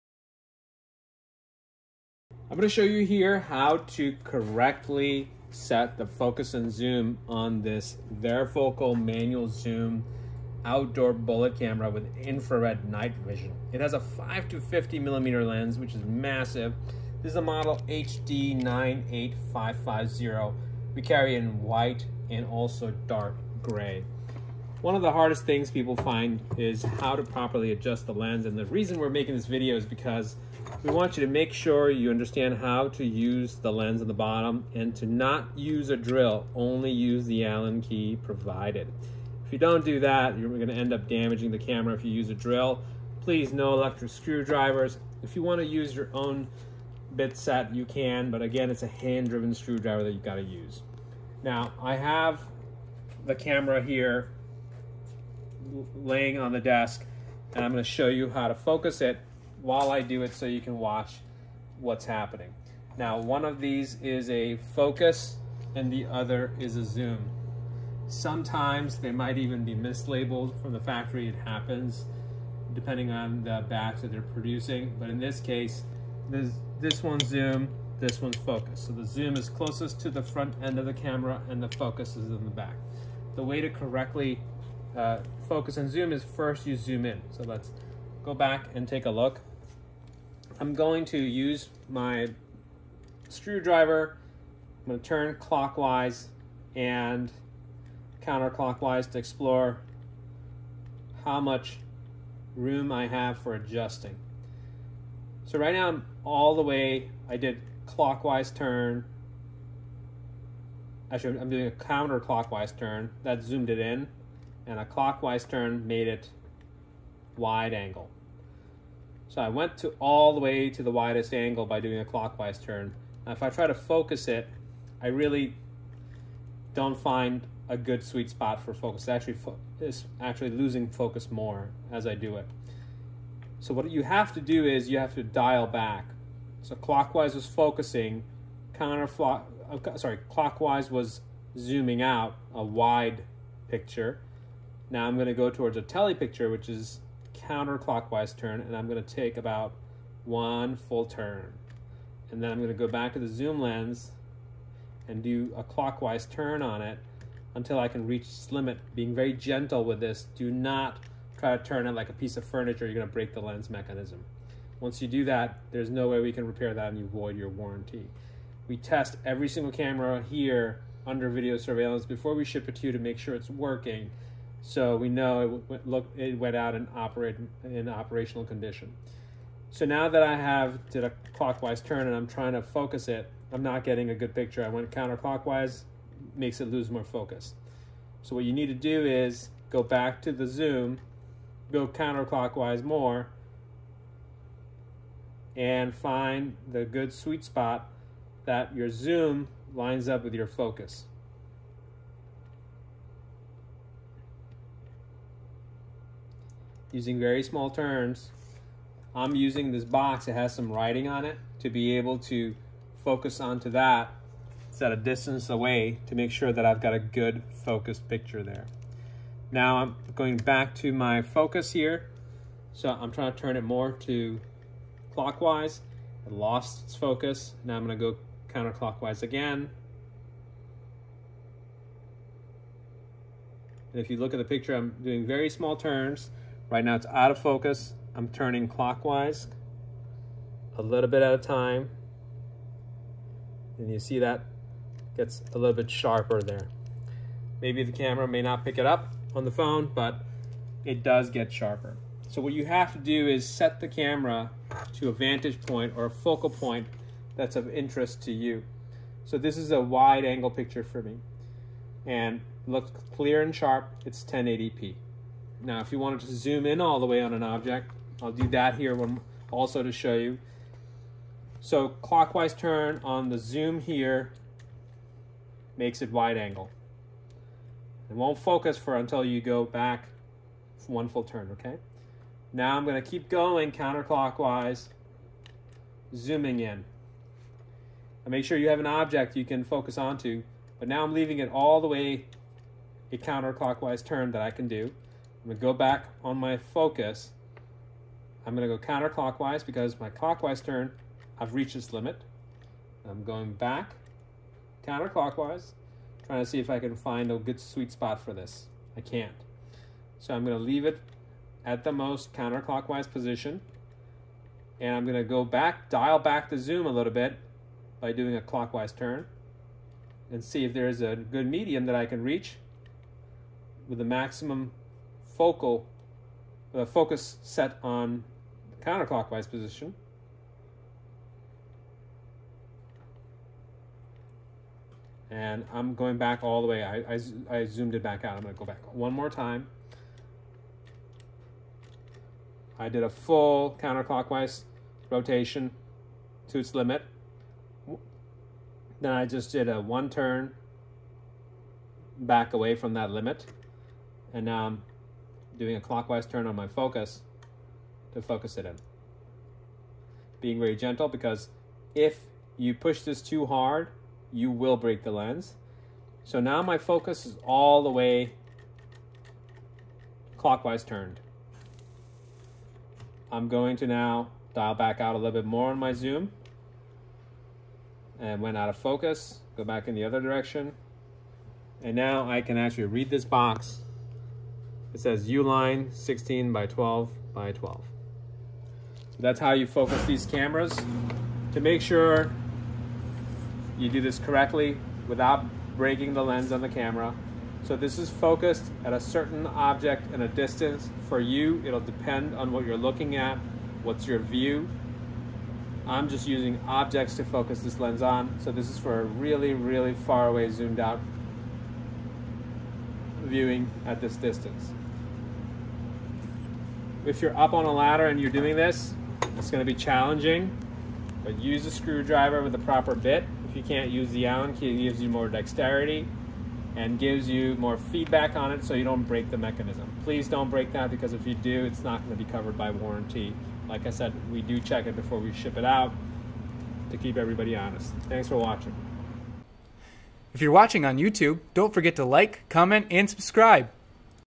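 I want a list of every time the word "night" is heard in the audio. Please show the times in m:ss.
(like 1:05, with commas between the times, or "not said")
0:12.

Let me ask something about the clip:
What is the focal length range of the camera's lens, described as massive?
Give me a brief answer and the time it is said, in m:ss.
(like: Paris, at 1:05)
5 to 50 millimeter, at 0:14.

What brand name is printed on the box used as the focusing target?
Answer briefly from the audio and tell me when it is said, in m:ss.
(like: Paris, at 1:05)
Uline, at 6:25.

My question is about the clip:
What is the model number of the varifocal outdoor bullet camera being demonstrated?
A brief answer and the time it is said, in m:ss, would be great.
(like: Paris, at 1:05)
HD98550, at 0:17.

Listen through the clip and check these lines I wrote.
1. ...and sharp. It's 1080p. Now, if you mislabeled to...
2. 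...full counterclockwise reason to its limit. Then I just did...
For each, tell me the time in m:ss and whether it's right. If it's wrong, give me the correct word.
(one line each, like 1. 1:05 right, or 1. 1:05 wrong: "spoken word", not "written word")
1. 4:23 wrong: "wanted", not "mislabeled"
2. 5:43 wrong: "rotation", not "reason".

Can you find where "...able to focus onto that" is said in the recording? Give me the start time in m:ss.
3:31.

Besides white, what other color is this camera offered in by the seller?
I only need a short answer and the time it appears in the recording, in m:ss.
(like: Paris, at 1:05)
dark gray, at 0:23.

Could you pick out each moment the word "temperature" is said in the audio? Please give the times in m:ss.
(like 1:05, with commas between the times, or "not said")
not said.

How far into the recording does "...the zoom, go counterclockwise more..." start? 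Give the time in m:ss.
3:10.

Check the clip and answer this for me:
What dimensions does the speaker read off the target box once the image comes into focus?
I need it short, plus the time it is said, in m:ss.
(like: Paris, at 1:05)
16 by 12 by 12, at 6:25.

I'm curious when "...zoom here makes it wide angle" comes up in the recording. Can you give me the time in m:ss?
4:33.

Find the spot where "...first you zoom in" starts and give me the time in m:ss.
1:26.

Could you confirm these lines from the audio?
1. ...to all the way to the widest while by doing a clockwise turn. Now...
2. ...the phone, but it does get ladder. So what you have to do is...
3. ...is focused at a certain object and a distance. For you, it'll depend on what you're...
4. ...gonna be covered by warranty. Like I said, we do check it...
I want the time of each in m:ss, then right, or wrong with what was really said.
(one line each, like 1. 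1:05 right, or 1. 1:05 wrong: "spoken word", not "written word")
1. 1:59 wrong: "angle", not "while"
2. 4:09 wrong: "sharper", not "ladder"
3. 6:37 right
4. 7:12 right.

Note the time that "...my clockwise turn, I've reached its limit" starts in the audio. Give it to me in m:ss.
4:59.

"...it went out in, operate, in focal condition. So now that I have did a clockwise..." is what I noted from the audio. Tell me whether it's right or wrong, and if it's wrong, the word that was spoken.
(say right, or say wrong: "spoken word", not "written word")
wrong: "operational", not "focal".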